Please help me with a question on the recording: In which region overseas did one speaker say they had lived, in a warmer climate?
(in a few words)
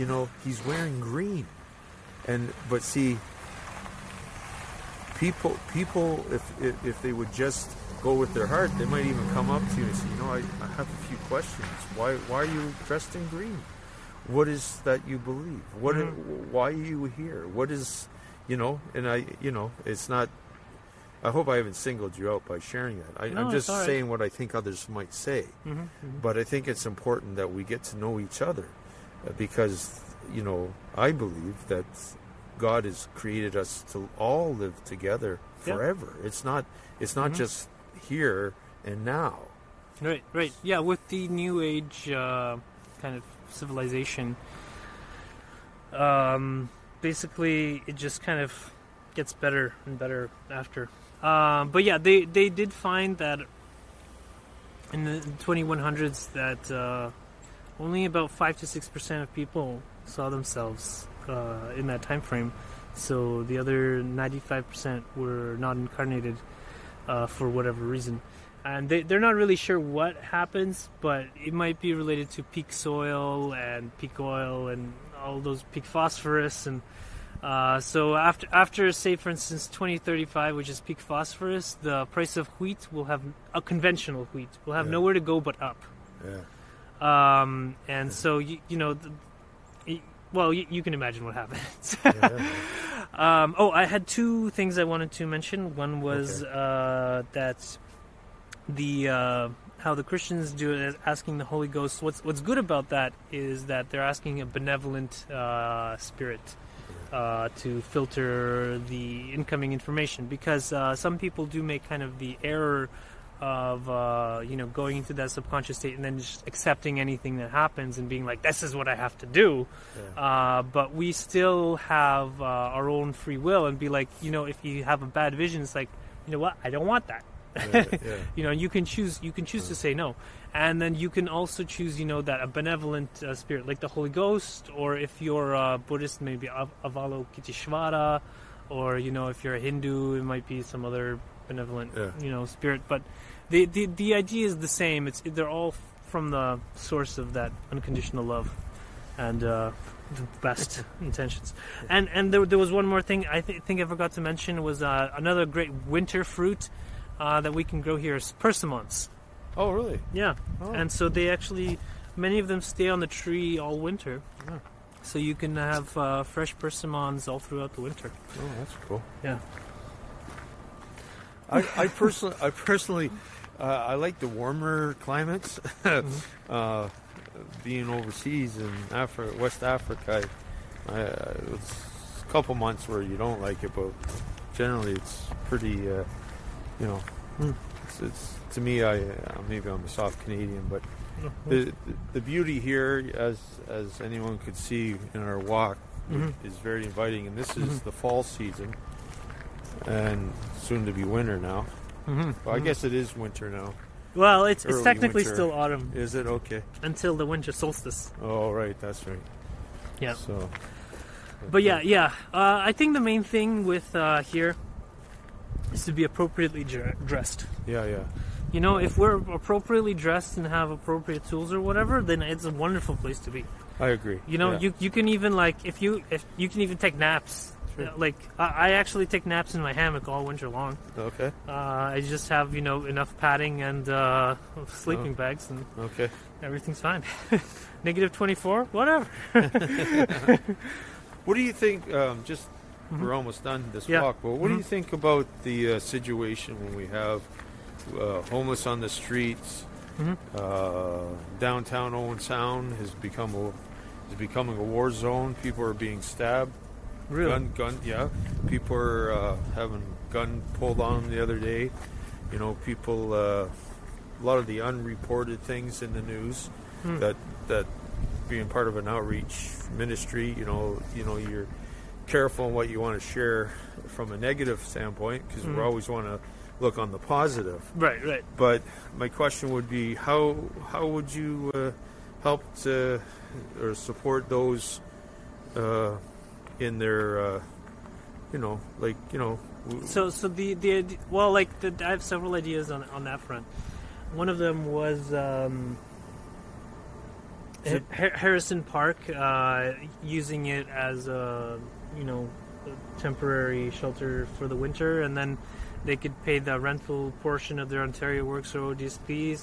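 West Africa.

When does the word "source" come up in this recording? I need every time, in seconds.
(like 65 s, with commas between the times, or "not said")
146 s.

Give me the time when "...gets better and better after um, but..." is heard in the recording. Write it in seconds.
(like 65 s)
49 s.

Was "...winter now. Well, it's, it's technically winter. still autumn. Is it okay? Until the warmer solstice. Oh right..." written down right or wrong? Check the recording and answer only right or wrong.
wrong.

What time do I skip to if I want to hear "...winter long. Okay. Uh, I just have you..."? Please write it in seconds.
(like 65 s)
230 s.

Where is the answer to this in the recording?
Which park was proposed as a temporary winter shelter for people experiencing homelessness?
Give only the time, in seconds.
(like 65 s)
297 s.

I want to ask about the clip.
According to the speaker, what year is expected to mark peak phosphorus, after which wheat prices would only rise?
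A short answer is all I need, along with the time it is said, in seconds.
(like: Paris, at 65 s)
2035, at 79 s.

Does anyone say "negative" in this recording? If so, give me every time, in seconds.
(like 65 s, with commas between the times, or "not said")
237 s, 274 s.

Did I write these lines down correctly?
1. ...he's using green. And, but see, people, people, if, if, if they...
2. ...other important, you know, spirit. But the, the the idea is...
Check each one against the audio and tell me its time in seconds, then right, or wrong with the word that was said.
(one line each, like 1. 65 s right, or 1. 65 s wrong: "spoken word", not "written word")
1. 0 s wrong: "wearing", not "using"
2. 140 s wrong: "benevolent", not "important".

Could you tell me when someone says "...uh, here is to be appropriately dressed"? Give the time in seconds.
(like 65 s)
213 s.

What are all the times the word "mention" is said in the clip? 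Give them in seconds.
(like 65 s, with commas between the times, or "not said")
95 s, 154 s.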